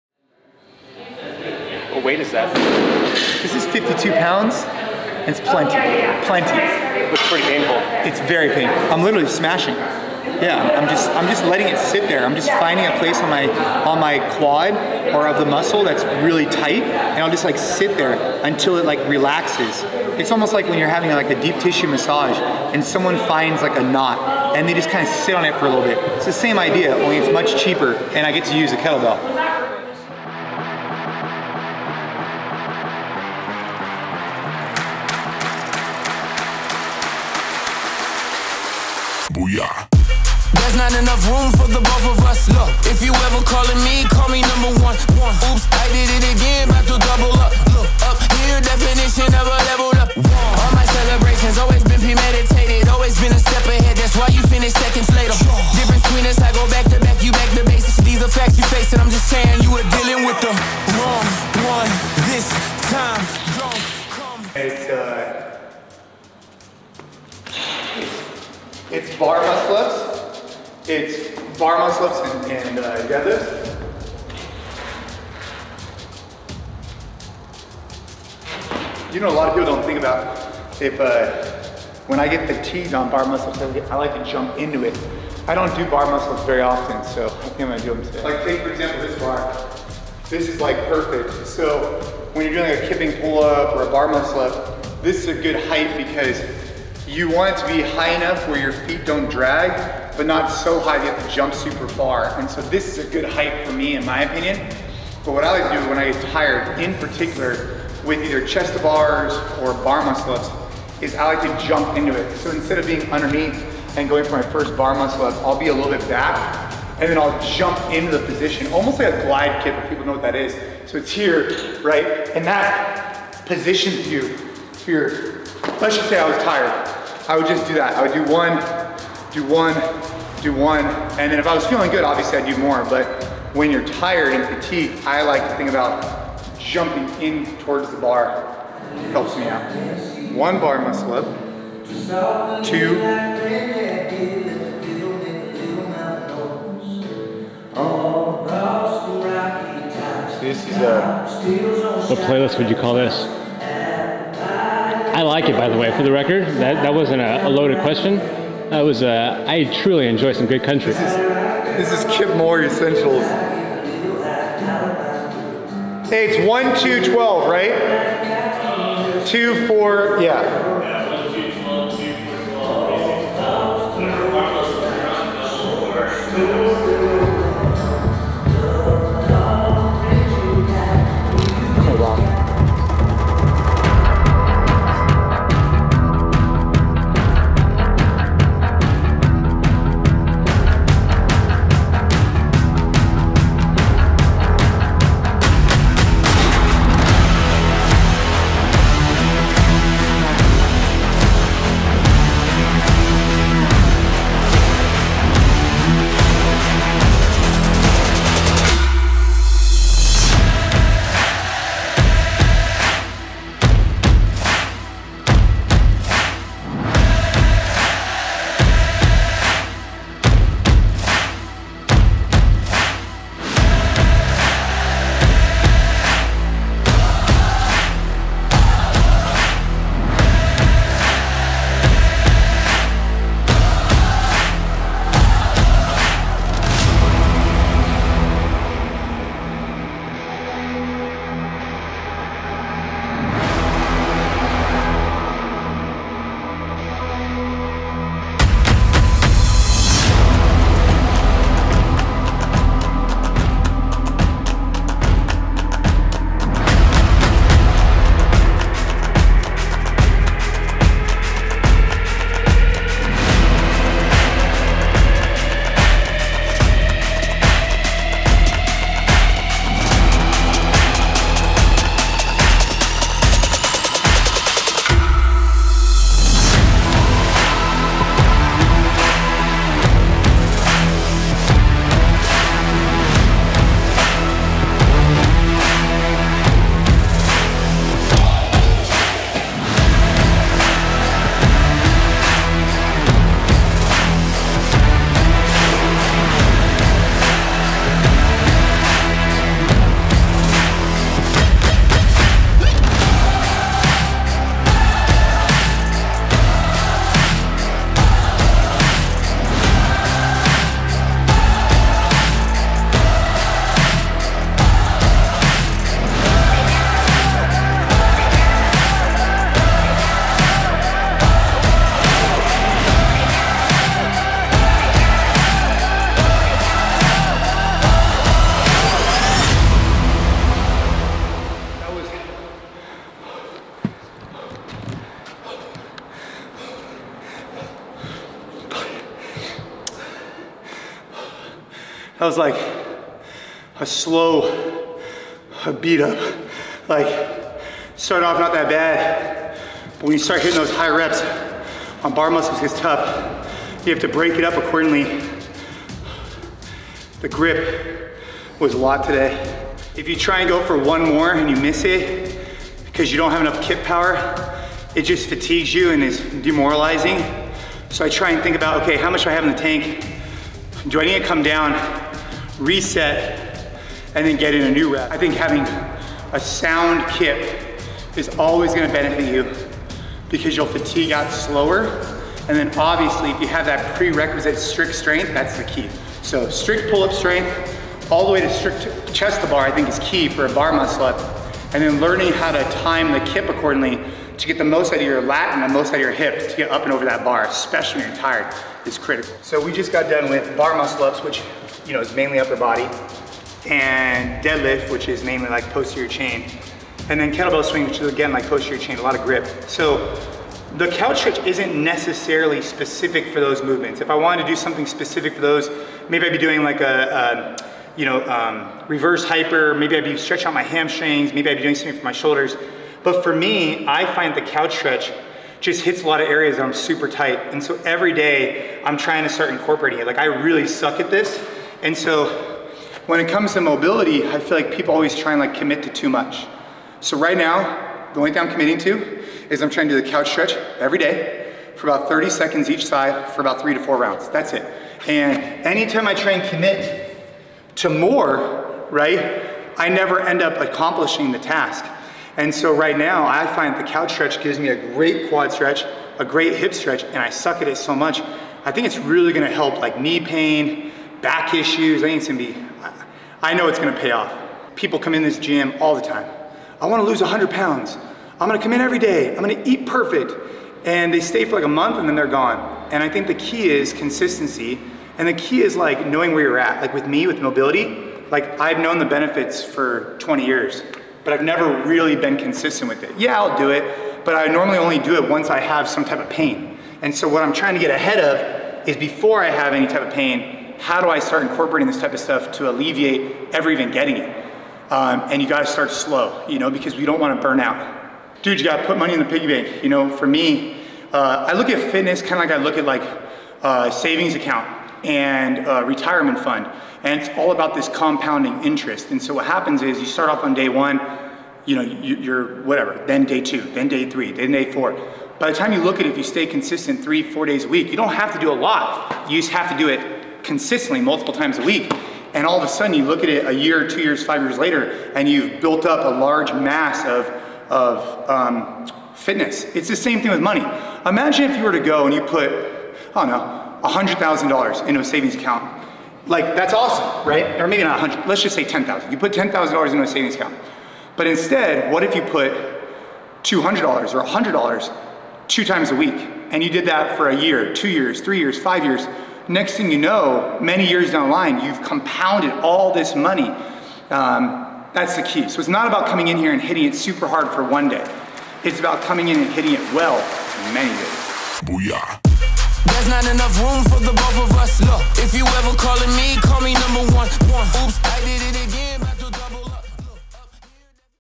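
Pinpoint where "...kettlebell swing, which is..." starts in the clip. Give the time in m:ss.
6:47.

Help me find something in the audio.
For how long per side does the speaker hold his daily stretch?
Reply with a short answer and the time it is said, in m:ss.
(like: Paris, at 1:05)
30 seconds, at 7:22.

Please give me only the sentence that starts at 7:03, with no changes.
But for me, I find the couch stretch just hits a lot of areas that I'm super tight.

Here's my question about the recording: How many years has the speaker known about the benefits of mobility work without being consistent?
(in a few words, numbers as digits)
20 years.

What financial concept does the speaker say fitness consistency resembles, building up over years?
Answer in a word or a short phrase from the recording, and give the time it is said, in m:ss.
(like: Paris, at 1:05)
compounding interest, at 8:27.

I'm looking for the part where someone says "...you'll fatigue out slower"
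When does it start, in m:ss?
6:20.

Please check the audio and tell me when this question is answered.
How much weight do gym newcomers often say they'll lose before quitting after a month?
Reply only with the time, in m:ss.
7:47.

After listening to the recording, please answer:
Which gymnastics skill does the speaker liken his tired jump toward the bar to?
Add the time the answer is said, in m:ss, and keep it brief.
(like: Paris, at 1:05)
glide kip, at 1:59.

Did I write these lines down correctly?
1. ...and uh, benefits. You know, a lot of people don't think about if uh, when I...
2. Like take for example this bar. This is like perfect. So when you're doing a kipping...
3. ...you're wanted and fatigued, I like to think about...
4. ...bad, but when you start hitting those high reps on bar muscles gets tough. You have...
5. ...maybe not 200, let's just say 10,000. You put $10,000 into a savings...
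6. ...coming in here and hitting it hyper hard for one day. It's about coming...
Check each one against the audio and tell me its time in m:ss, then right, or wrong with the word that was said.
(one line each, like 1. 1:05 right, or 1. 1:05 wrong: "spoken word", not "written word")
1. 1:12 wrong: "deadlifts", not "benefits"
2. 1:28 right
3. 2:13 wrong: "tired", not "wanted"
4. 5:48 right
5. 8:57 wrong: "100", not "200"
6. 9:16 wrong: "super", not "hyper".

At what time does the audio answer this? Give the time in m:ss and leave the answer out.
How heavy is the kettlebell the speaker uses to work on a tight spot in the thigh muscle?
0:03.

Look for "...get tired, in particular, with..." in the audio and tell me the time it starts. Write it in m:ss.
1:46.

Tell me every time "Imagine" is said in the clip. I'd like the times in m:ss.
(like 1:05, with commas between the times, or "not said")
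8:51.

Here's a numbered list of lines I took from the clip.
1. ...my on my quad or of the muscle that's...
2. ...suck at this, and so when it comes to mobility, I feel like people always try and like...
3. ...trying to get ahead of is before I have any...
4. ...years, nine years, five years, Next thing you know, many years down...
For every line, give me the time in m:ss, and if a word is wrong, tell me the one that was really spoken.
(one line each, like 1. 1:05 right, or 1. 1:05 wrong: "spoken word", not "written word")
1. 0:13 right
2. 7:10 right
3. 8:07 right
4. 9:07 wrong: "three", not "nine".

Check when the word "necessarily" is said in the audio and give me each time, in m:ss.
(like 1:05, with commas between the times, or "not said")
6:51.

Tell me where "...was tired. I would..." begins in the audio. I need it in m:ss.
2:06.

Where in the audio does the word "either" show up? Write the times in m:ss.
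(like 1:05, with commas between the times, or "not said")
1:48.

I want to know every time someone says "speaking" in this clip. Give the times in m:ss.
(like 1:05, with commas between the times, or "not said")
not said.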